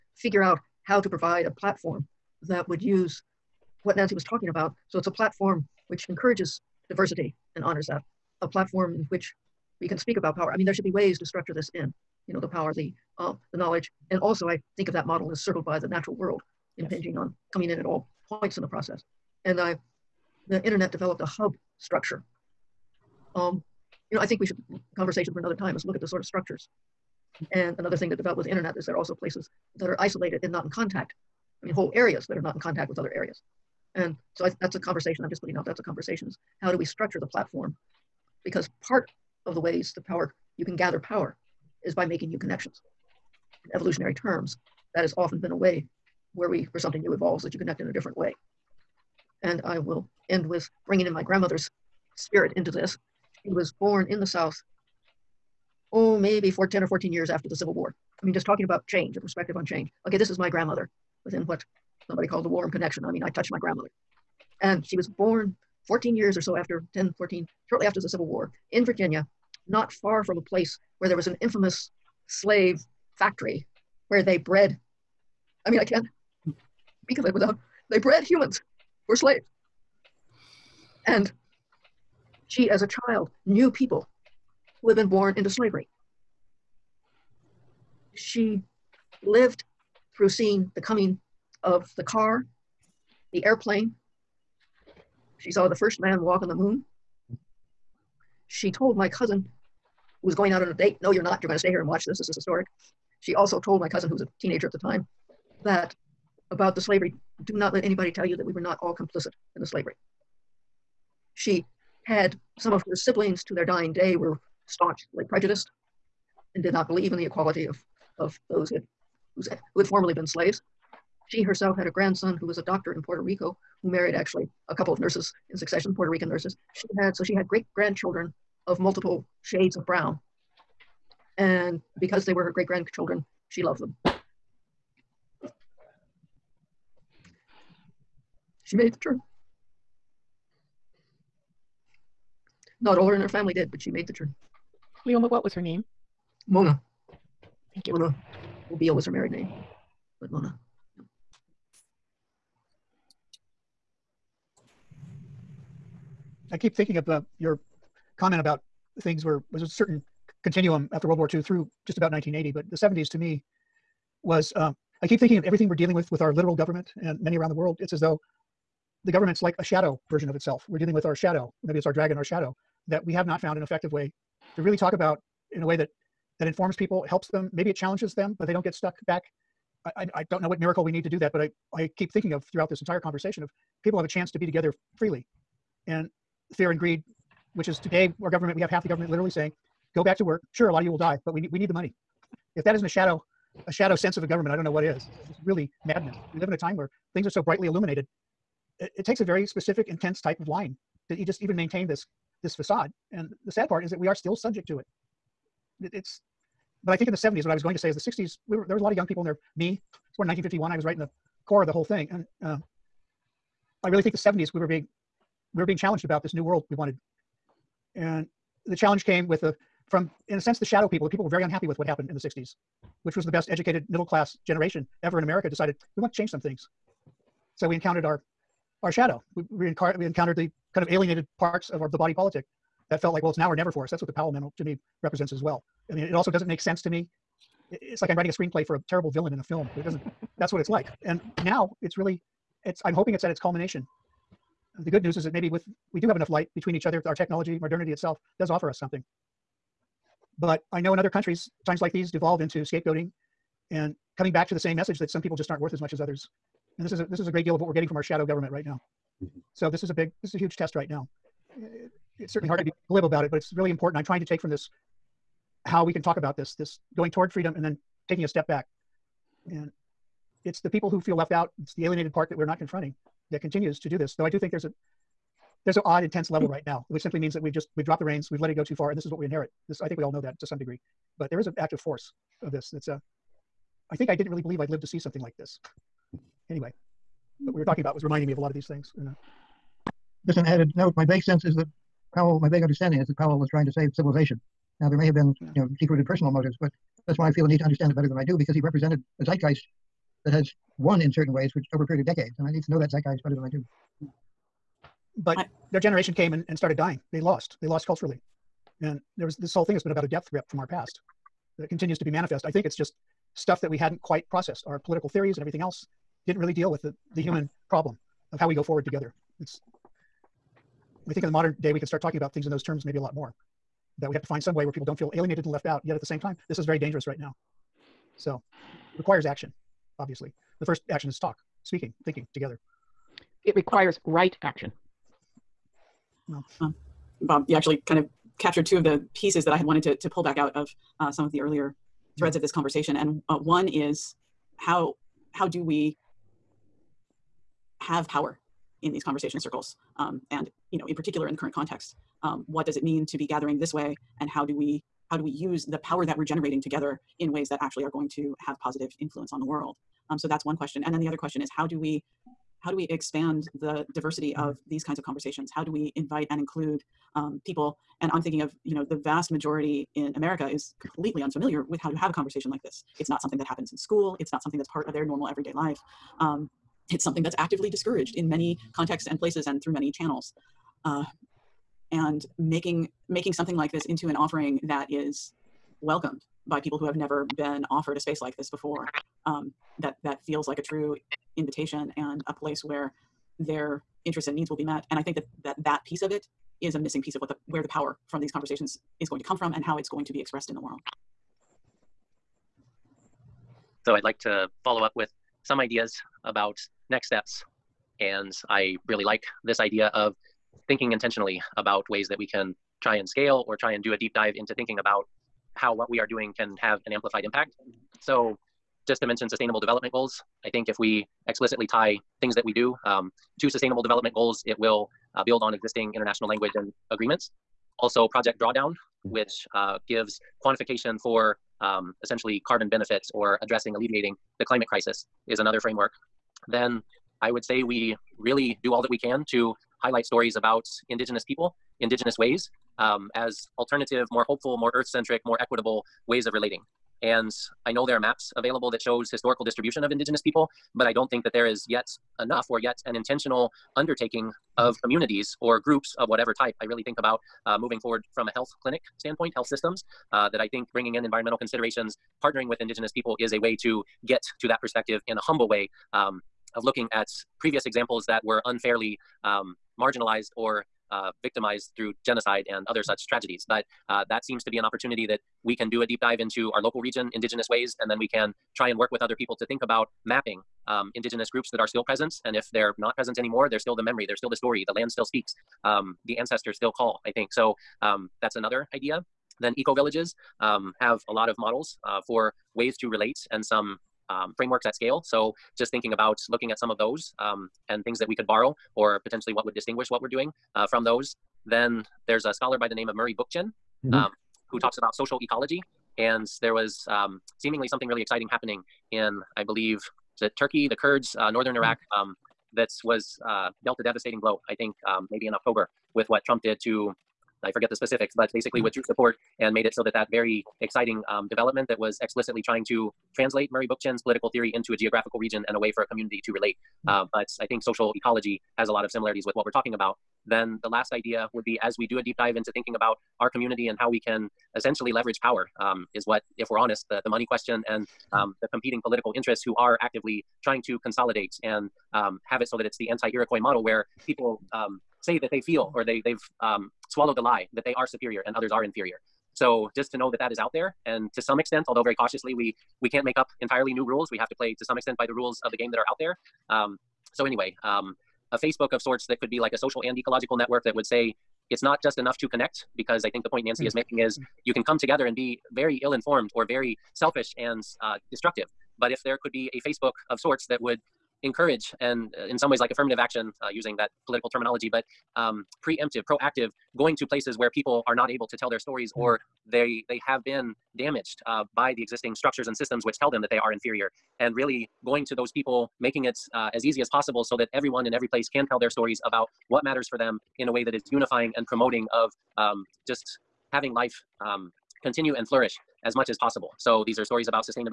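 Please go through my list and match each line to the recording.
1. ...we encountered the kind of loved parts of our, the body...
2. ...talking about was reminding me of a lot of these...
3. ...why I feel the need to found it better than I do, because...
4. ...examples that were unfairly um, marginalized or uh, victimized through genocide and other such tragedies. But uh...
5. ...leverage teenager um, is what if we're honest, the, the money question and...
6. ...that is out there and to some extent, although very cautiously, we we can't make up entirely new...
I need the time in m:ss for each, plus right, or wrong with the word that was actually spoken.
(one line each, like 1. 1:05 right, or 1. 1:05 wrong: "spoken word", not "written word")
1. 3:49 wrong: "alienated", not "loved"
2. 4:47 right
3. 4:57 wrong: "understand", not "found"
4. 7:47 right
5. 8:54 wrong: "power", not "teenager"
6. 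9:10 right.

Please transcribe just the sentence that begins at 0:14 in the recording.
And also I think of that model as circled by the natural world, impinging yes.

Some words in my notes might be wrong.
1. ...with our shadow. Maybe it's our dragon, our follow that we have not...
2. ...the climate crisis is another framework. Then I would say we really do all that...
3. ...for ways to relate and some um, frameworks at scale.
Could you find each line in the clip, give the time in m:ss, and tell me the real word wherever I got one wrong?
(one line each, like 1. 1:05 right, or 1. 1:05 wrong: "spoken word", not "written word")
1. 2:50 wrong: "shadow", not "follow"
2. 7:14 right
3. 8:12 right.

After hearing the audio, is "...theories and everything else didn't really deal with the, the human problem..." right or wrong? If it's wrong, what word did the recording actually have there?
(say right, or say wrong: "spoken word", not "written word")
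right.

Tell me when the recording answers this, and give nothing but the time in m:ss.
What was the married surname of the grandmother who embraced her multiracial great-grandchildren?
2:28.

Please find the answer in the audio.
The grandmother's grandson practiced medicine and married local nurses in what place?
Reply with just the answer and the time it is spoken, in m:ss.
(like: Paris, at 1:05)
Puerto Rico, at 2:03.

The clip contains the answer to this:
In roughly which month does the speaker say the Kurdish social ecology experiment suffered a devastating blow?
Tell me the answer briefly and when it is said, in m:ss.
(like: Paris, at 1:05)
October, at 8:35.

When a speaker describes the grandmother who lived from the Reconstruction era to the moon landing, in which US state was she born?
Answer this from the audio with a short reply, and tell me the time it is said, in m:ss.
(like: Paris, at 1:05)
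Virginia, at 1:08.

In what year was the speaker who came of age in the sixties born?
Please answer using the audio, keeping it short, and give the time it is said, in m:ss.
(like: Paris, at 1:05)
1951, at 3:30.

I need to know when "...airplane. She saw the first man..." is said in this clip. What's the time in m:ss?
1:33.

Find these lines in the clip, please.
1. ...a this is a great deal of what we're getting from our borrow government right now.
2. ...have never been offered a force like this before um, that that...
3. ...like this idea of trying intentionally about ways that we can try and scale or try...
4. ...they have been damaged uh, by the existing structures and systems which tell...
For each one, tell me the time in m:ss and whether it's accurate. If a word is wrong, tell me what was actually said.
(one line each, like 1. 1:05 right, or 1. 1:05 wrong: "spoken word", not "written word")
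1. 4:16 wrong: "shadow", not "borrow"
2. 6:26 wrong: "space", not "force"
3. 6:49 wrong: "thinking", not "trying"
4. 9:39 right.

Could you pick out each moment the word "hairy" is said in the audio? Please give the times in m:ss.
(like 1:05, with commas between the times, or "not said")
not said.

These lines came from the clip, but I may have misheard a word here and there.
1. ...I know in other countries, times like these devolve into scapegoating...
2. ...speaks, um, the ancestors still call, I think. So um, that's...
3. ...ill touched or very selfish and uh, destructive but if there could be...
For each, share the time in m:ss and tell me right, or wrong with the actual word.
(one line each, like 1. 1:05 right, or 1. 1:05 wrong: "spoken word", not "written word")
1. 4:10 right
2. 8:05 right
3. 9:25 wrong: "informed", not "touched".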